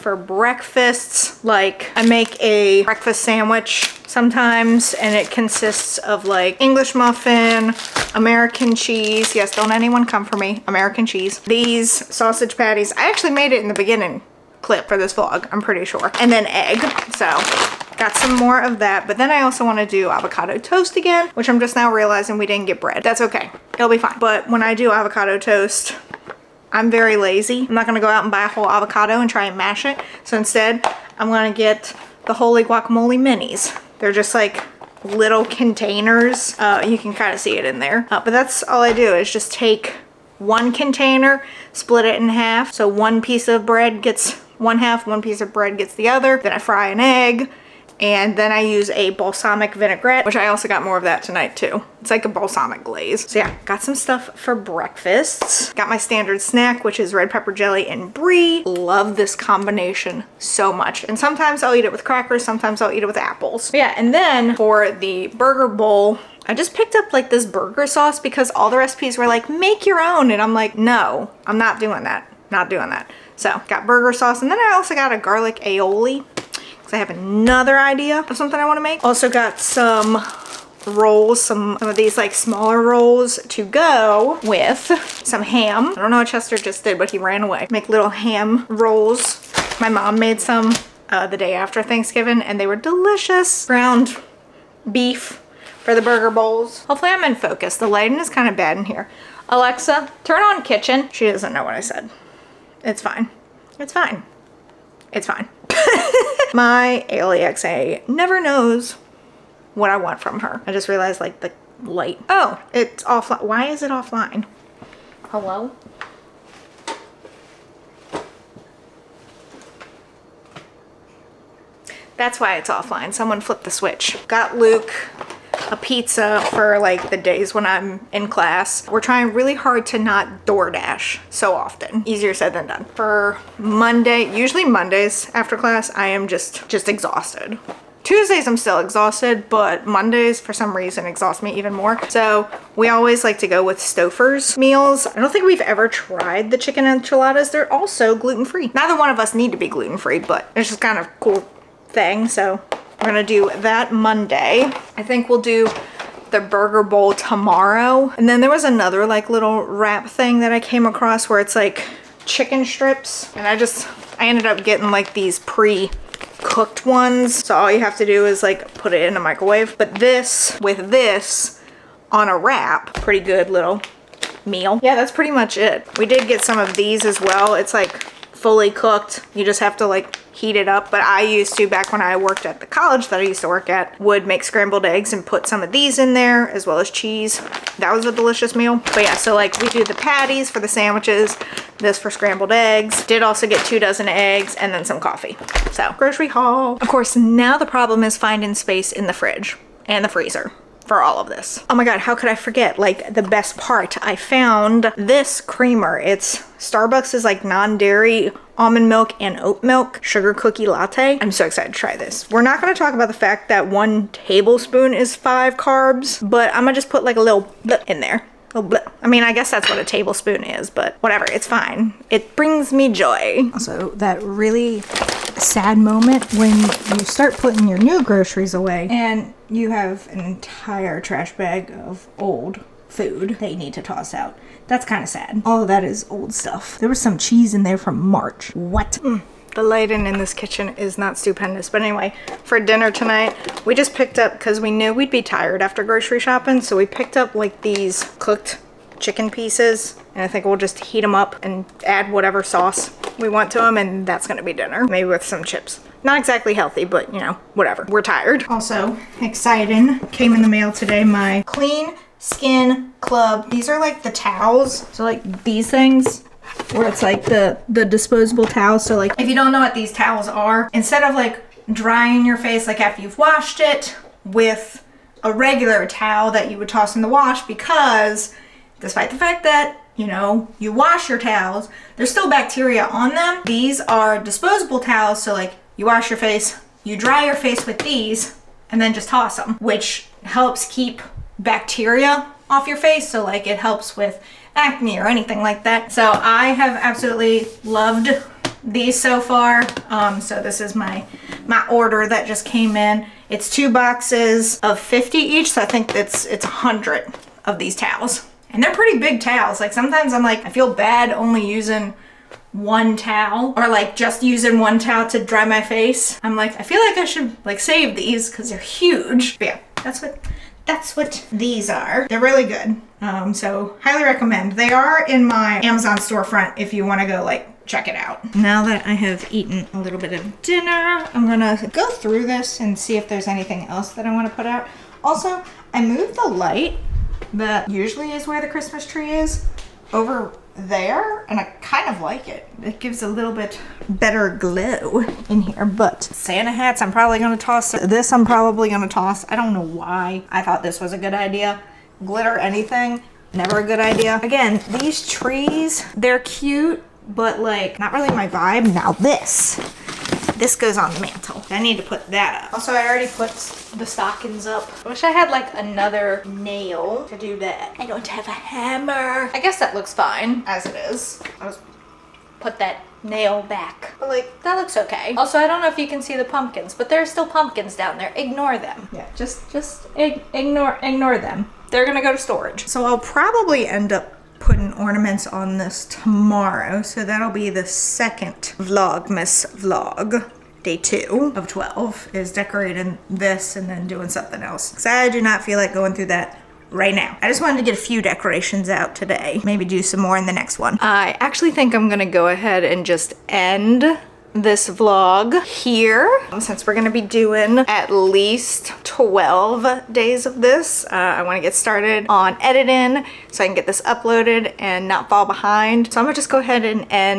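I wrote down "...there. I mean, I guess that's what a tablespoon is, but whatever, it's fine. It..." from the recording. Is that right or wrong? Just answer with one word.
right.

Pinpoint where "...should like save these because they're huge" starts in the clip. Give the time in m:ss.
5:17.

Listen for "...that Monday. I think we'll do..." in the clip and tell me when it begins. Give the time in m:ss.
2:33.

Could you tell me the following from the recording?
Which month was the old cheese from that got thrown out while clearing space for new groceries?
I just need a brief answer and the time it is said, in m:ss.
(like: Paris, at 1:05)
March, at 3:57.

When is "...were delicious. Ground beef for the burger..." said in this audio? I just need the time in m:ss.
1:32.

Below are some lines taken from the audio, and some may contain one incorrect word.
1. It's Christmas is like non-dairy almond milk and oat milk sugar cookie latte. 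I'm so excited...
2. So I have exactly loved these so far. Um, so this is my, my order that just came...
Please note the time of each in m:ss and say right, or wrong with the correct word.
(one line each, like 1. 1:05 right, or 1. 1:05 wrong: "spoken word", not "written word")
1. 3:25 wrong: "Starbucks", not "Christmas"
2. 4:55 wrong: "absolutely", not "exactly".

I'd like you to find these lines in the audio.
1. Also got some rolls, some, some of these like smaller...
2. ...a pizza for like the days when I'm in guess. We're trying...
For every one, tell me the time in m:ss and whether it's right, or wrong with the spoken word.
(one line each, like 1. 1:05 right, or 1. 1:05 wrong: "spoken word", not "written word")
1. 1:19 right
2. 2:05 wrong: "class", not "guess".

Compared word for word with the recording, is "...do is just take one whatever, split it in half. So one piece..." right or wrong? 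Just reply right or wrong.
wrong.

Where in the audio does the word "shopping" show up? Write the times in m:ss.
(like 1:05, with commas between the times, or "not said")
4:06.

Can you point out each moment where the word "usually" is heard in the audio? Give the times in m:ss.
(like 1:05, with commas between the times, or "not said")
2:14, 5:37.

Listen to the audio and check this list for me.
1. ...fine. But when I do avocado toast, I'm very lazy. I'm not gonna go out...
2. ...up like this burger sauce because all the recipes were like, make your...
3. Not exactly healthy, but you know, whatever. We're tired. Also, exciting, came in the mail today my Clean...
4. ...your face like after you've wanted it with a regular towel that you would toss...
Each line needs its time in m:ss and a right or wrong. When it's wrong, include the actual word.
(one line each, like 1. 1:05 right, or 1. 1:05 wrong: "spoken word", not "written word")
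1. 0:23 right
2. 1:06 right
3. 4:16 right
4. 4:32 wrong: "washed", not "wanted".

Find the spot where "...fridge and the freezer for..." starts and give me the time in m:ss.
3:19.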